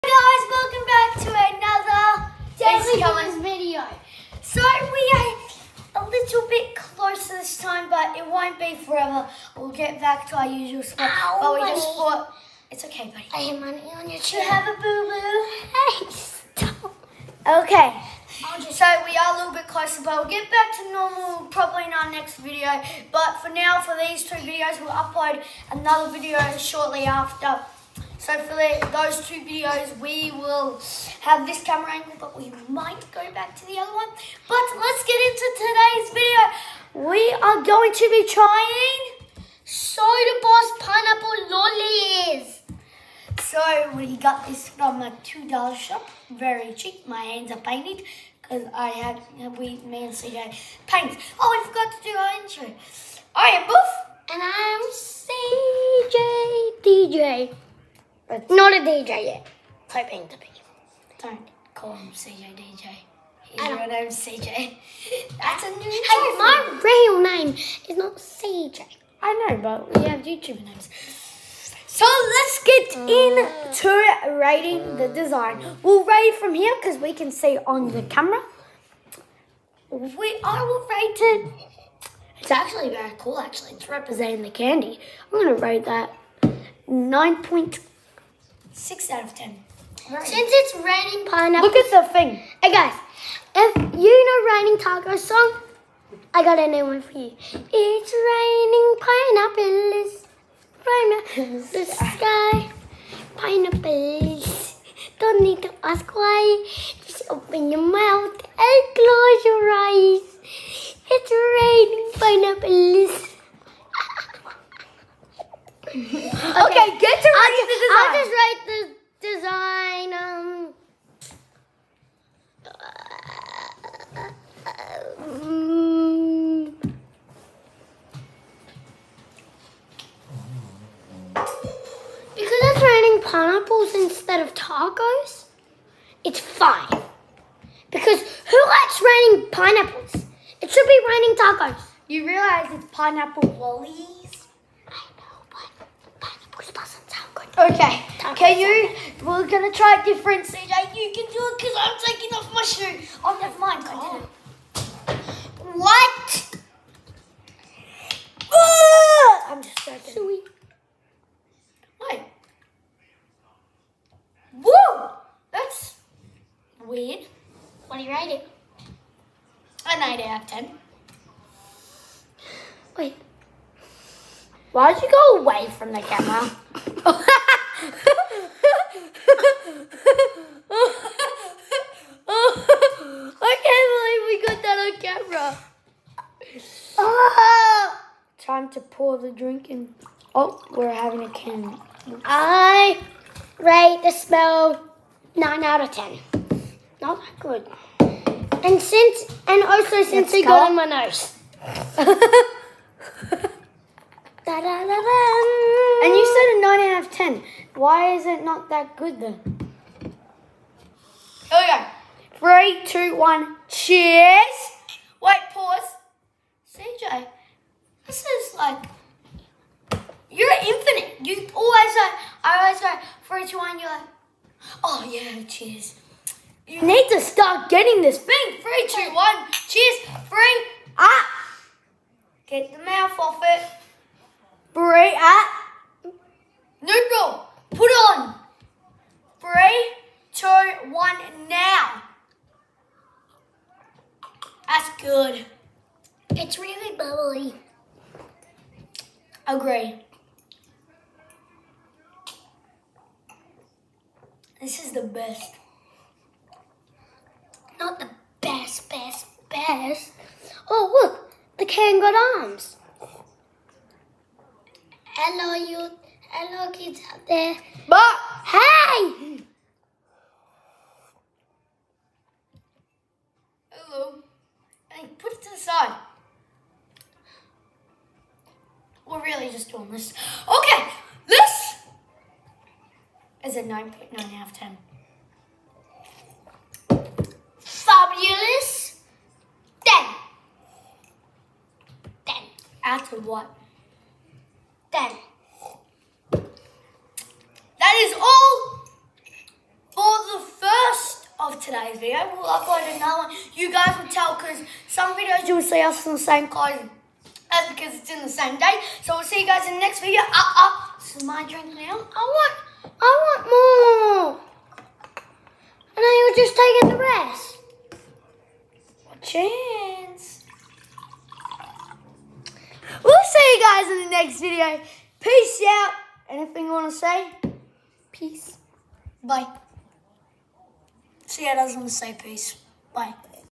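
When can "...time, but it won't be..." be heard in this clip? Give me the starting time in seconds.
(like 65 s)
7 s.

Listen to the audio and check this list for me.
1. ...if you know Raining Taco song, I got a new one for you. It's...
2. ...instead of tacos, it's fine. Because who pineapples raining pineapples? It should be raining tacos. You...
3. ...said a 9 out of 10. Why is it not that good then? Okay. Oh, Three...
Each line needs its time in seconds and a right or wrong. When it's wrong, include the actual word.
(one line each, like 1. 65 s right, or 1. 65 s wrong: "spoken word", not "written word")
1. 93 s right
2. 133 s wrong: "likes", not "pineapples"
3. 206 s right.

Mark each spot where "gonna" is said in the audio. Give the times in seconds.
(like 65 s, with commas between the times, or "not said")
85 s, 149 s.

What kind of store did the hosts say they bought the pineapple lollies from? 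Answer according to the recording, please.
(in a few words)
$2 shop.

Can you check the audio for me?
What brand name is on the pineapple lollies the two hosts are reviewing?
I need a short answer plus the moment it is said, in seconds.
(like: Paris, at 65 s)
Soda Boss, at 39 s.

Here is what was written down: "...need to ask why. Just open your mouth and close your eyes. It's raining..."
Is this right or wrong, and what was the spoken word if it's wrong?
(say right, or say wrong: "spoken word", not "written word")
right.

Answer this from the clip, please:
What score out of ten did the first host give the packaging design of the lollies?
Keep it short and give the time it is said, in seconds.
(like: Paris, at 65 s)
9.6, at 86 s.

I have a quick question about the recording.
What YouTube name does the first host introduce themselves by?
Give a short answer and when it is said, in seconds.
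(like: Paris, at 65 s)
Boof, at 53 s.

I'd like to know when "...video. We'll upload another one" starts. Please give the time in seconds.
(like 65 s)
301 s.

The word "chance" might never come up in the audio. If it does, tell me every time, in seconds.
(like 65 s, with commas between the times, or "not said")
319 s.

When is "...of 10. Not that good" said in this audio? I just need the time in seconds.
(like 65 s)
195 s.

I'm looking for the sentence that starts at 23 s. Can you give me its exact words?
But for now, for these two videos, we'll upload another video shortly after.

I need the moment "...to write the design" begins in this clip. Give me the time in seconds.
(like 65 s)
116 s.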